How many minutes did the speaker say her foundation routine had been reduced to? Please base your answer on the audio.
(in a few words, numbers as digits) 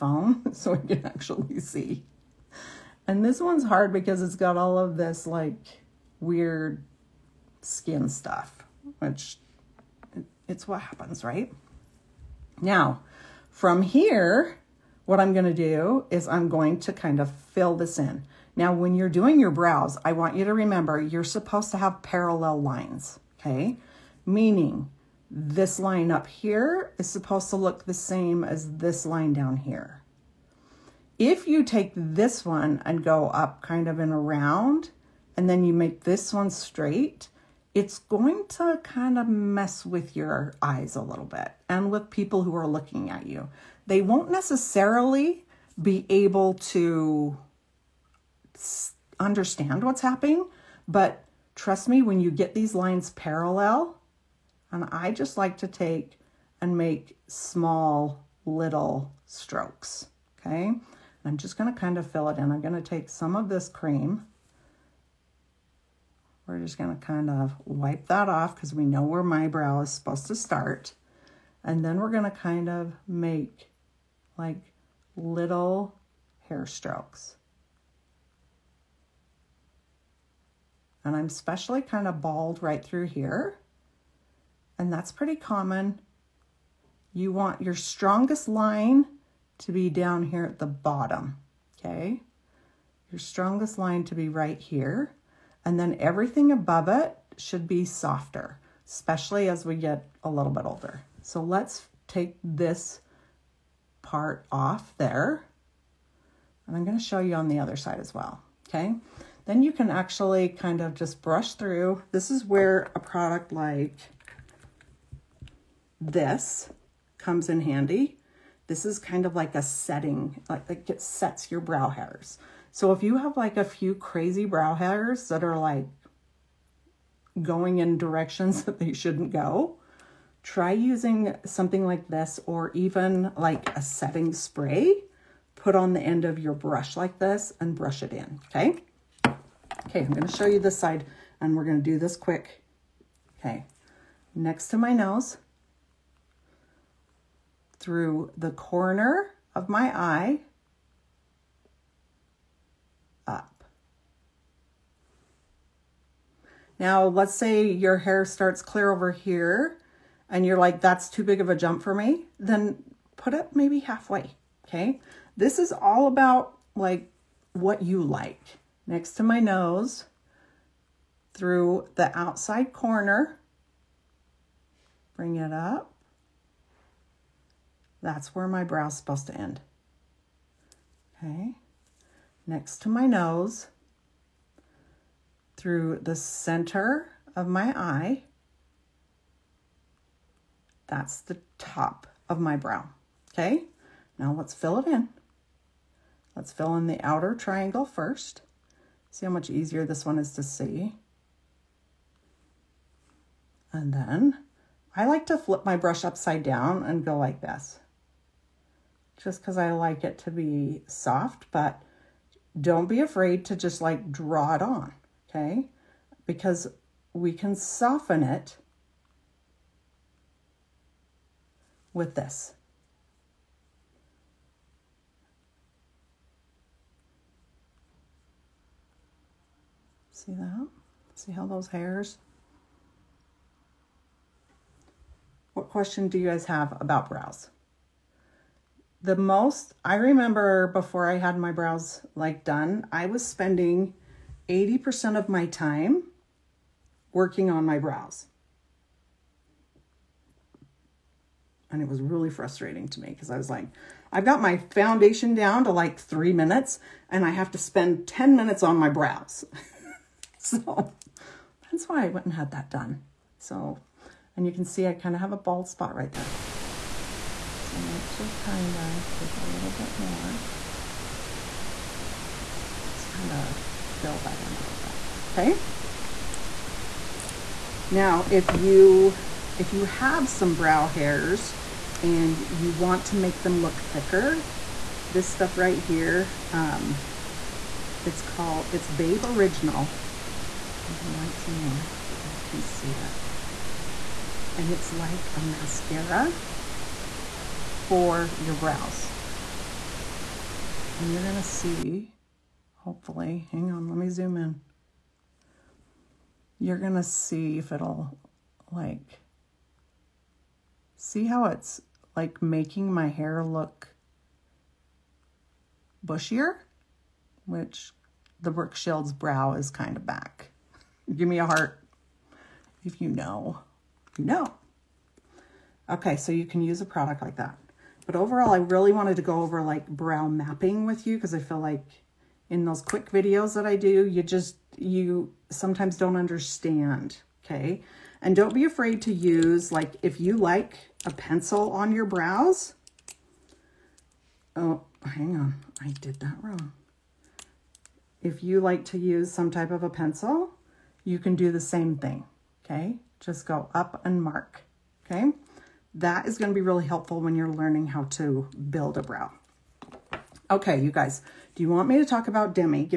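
3 minutes.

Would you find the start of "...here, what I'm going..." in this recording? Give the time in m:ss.
0:13.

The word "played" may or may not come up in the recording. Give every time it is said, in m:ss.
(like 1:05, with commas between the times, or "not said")
not said.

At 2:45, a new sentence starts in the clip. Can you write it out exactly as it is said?
This is all about like what you like.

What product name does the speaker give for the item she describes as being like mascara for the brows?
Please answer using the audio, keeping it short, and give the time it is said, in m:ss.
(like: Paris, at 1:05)
Babe Original, at 4:48.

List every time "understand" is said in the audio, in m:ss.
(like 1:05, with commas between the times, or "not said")
0:49, 5:36.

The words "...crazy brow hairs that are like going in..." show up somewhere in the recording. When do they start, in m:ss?
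2:03.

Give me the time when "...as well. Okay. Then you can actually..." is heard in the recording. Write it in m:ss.
1:47.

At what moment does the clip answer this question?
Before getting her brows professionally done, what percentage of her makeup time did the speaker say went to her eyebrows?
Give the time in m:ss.
4:04.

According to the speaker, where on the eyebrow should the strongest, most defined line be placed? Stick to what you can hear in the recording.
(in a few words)
At the bottom.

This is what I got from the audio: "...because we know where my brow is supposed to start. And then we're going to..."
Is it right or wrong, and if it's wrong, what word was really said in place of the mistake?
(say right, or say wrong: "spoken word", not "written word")
right.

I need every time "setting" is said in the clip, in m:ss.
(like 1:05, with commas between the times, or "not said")
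1:59, 2:13.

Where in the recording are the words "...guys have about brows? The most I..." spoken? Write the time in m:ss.
3:56.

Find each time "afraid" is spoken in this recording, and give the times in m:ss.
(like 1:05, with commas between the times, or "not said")
3:32, 5:38.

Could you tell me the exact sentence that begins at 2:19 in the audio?
Okay, I'm gonna show you this side and we're gonna do this quick.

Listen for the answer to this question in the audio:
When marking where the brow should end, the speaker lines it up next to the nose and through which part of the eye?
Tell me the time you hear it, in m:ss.
2:51.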